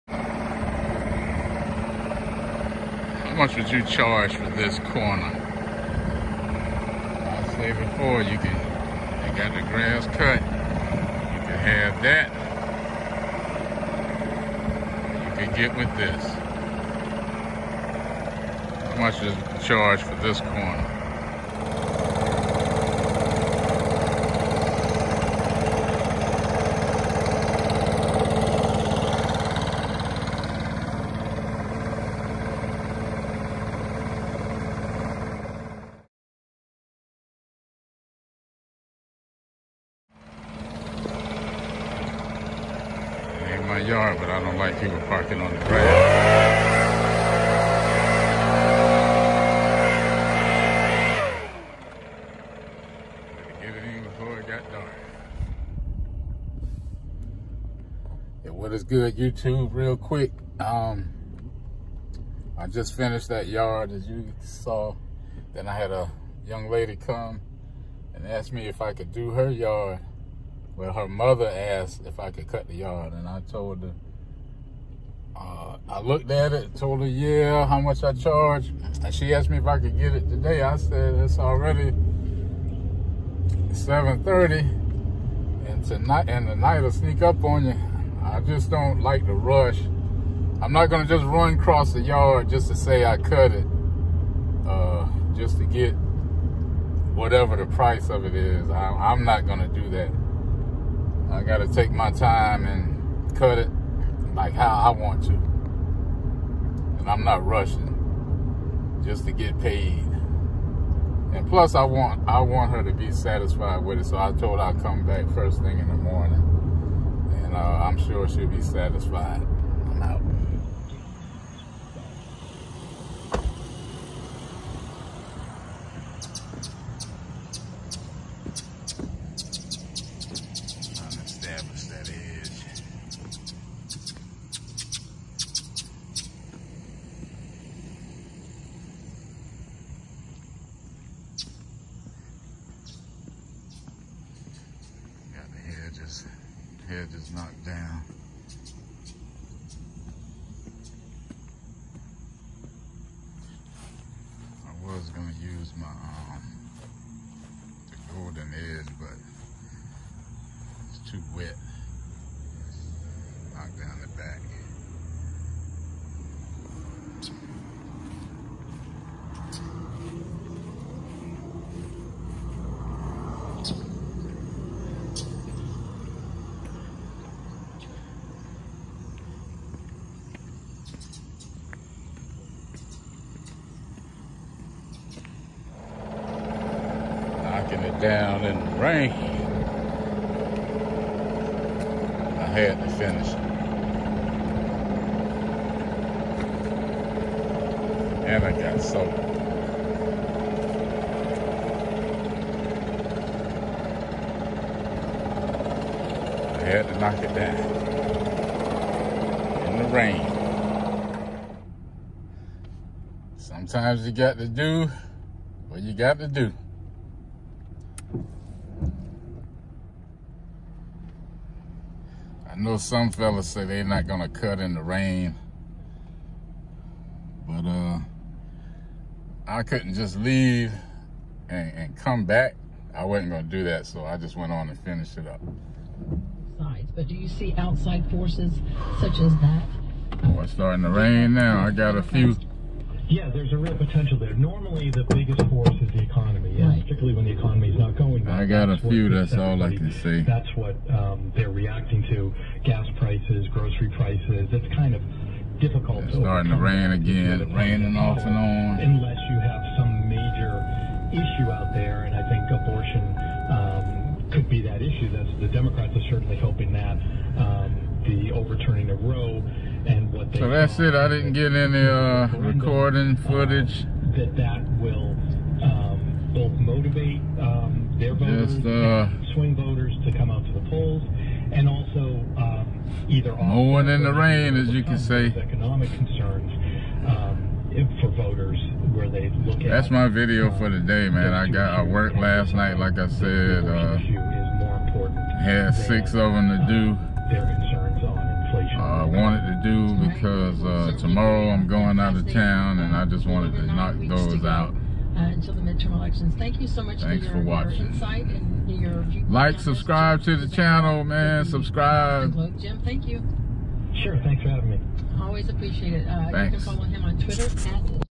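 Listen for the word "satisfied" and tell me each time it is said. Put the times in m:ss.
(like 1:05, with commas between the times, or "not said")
1:53, 1:58.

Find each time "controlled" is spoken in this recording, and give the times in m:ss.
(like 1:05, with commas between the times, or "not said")
not said.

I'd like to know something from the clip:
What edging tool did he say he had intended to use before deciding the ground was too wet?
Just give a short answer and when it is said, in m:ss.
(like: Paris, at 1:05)
the golden edge, at 2:37.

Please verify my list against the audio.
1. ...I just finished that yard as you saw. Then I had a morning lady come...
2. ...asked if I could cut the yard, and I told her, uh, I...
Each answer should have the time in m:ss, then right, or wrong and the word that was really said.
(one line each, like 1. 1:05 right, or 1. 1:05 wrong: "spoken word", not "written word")
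1. 1:02 wrong: "young", not "morning"
2. 1:11 right.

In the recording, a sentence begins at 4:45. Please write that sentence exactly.
Economic concerns um, for voters where they look That's at.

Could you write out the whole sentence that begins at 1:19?
And she asked me if I could get it today.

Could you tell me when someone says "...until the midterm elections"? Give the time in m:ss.
5:05.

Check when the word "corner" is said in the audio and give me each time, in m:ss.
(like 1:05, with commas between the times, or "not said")
0:04, 0:20.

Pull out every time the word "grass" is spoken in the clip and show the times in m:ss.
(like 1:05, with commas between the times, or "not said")
0:09, 0:45.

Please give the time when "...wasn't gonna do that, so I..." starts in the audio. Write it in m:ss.
3:53.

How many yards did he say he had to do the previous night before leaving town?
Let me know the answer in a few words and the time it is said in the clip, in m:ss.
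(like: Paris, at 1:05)
6, at 4:55.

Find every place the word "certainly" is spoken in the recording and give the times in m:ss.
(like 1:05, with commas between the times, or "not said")
4:26.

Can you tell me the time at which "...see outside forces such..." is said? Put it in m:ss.
3:57.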